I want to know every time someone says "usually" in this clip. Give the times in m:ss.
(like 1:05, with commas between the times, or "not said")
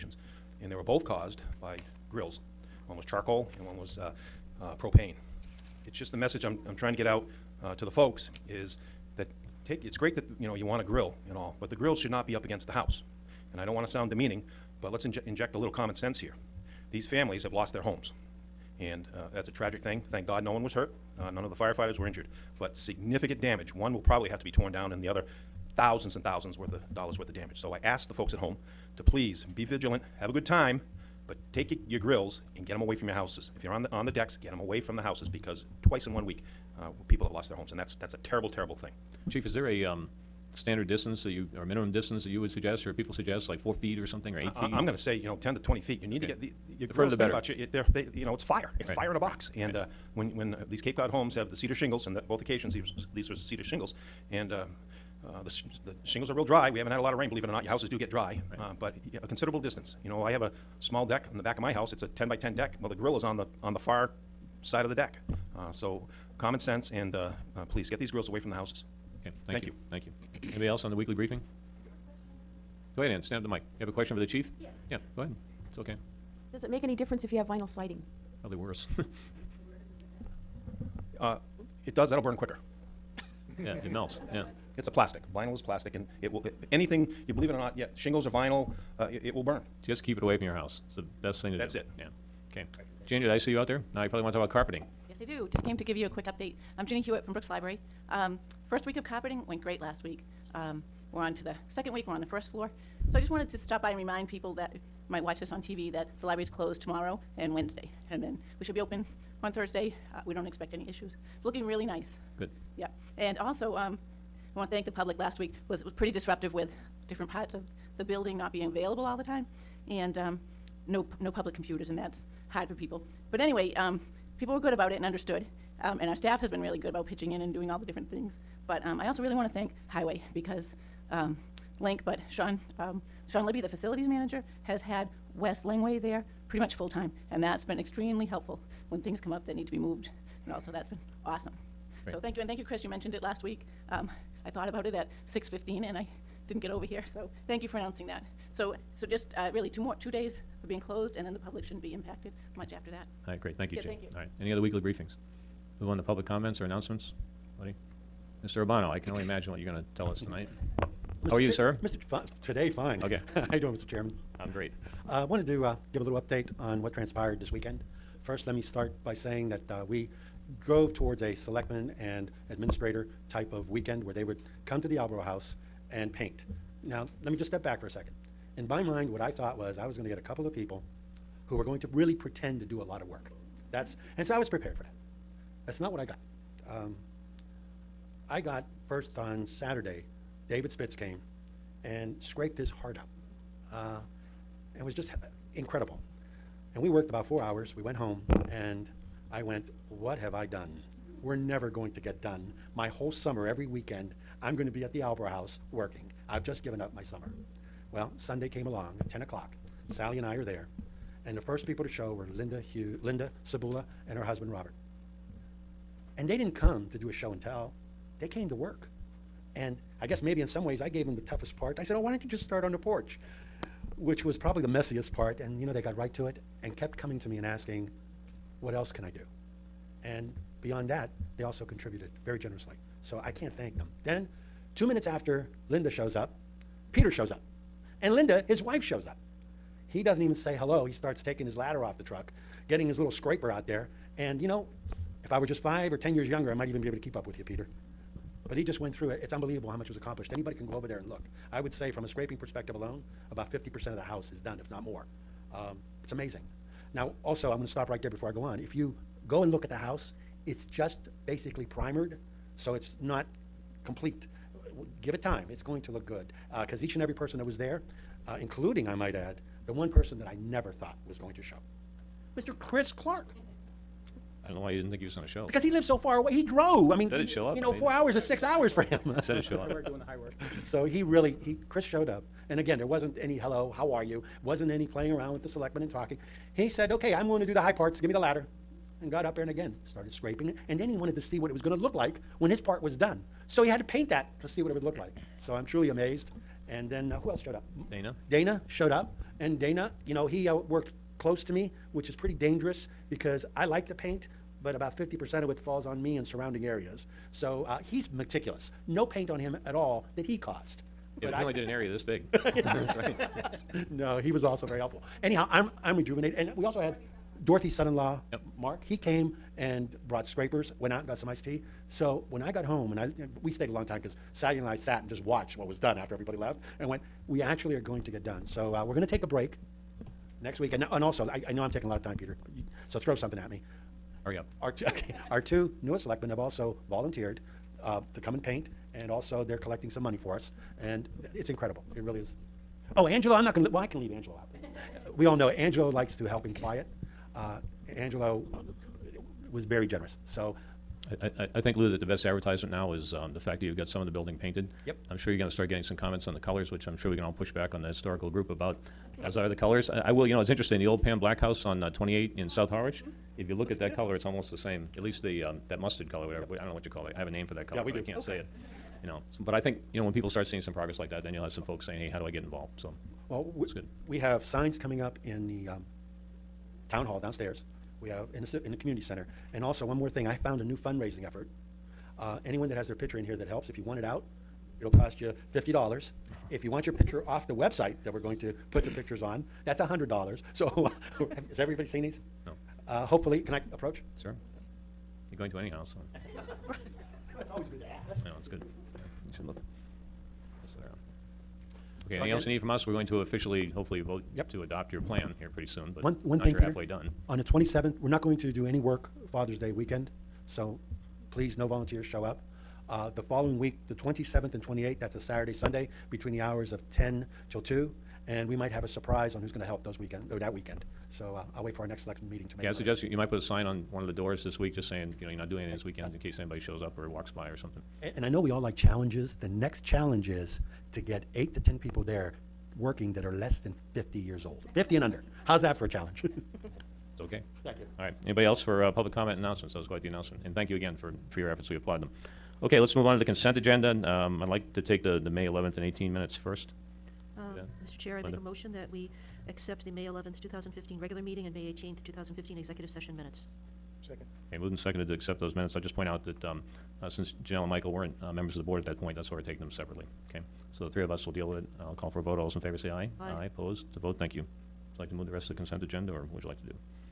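not said.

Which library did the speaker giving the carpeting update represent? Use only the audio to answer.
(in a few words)
Brooks Library.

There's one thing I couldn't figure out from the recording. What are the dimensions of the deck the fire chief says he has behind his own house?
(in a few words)
10 by 10.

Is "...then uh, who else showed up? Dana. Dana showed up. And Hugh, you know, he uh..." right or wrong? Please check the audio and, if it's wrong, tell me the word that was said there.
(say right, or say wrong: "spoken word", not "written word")
wrong: "Dana", not "Hugh".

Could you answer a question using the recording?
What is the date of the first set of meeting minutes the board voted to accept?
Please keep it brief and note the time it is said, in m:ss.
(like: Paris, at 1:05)
May 11th, 2015, at 7:29.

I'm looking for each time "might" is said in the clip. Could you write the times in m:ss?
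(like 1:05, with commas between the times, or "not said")
1:45, 4:06, 4:28, 6:58, 7:03.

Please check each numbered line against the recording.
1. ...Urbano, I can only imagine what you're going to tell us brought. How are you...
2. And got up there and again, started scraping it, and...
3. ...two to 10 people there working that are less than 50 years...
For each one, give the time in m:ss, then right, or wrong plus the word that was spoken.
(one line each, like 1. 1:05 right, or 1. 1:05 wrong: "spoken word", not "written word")
1. 2:38 wrong: "tonight", not "brought"
2. 4:49 right
3. 7:11 wrong: "eight", not "two".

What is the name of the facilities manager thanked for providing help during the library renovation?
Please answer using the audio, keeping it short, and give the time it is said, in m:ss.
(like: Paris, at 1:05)
Sean Libby, at 2:13.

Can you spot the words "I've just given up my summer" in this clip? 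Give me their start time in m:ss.
3:26.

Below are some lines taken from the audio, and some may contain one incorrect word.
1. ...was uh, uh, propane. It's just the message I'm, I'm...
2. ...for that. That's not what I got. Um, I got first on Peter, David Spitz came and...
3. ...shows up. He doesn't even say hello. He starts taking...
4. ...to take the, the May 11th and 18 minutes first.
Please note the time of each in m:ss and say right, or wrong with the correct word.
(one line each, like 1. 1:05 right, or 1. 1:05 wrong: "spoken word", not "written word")
1. 0:03 right
2. 3:04 wrong: "Saturday", not "Peter"
3. 3:58 right
4. 7:24 right.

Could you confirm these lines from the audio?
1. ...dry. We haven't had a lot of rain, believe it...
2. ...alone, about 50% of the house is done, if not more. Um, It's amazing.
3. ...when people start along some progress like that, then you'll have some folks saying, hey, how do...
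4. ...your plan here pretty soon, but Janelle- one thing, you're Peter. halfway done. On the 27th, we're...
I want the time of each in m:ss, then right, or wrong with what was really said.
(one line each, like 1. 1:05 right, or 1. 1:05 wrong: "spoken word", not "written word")
1. 0:56 right
2. 4:12 right
3. 6:10 wrong: "seeing", not "along"
4. 6:44 wrong: "One", not "Janelle".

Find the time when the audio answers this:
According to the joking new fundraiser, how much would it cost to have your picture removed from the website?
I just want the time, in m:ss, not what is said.
6:29.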